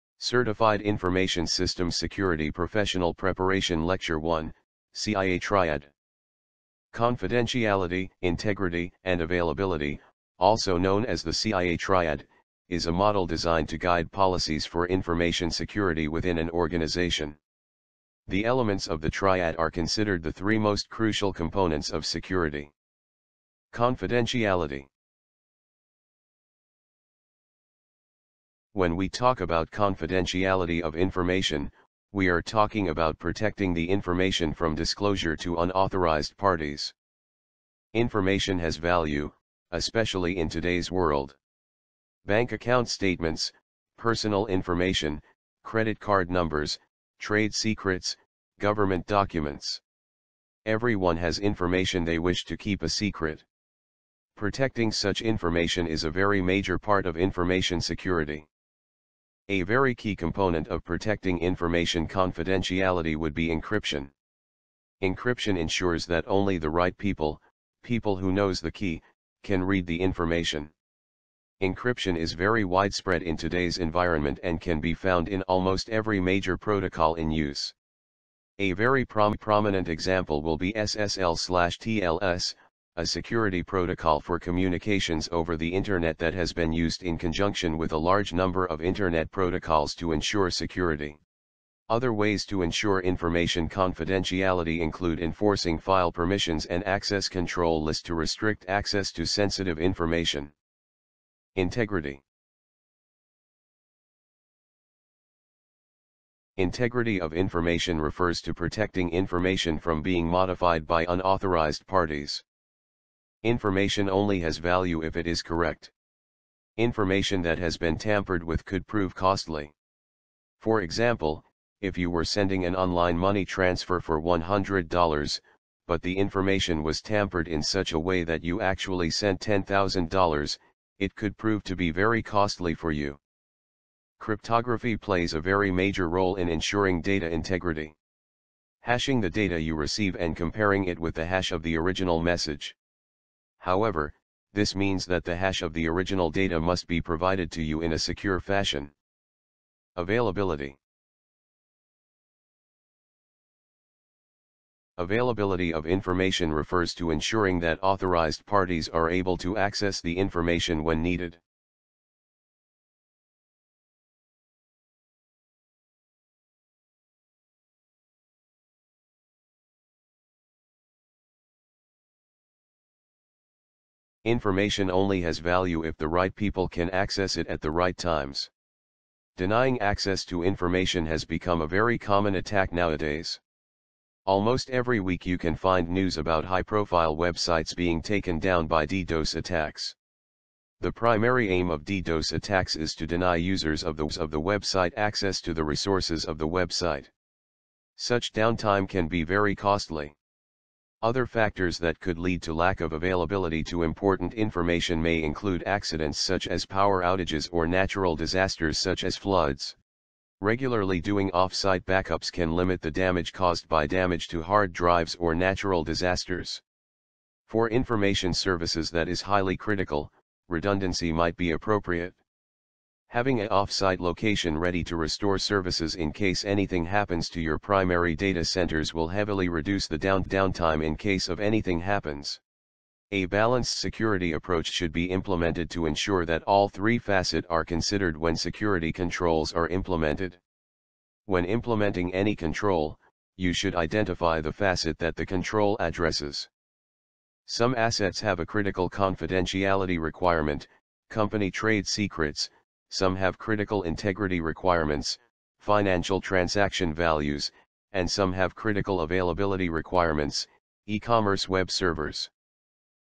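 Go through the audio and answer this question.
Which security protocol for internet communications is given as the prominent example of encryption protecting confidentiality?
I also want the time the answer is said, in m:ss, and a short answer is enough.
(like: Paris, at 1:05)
SSL TLS, at 1:20.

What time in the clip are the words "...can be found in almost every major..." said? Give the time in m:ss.
1:14.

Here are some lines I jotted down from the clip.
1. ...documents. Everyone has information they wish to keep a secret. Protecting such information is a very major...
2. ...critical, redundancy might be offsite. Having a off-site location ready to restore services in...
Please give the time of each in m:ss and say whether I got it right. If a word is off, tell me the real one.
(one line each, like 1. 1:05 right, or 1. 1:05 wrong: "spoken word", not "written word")
1. 0:49 right
2. 3:39 wrong: "appropriate", not "offsite".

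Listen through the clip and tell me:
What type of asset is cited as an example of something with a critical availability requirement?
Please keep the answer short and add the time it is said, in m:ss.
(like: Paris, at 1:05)
e-commerce web servers, at 4:20.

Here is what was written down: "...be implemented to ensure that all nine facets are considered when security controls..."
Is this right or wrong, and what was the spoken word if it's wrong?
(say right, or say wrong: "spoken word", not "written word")
wrong: "three", not "nine".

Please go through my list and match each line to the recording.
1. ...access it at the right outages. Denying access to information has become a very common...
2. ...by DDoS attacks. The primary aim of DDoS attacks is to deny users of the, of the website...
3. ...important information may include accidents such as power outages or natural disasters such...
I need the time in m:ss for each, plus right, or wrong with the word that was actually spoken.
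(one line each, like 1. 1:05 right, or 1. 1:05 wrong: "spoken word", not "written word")
1. 2:56 wrong: "times", not "outages"
2. 3:08 right
3. 3:23 right.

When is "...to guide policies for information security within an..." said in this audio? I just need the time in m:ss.
0:13.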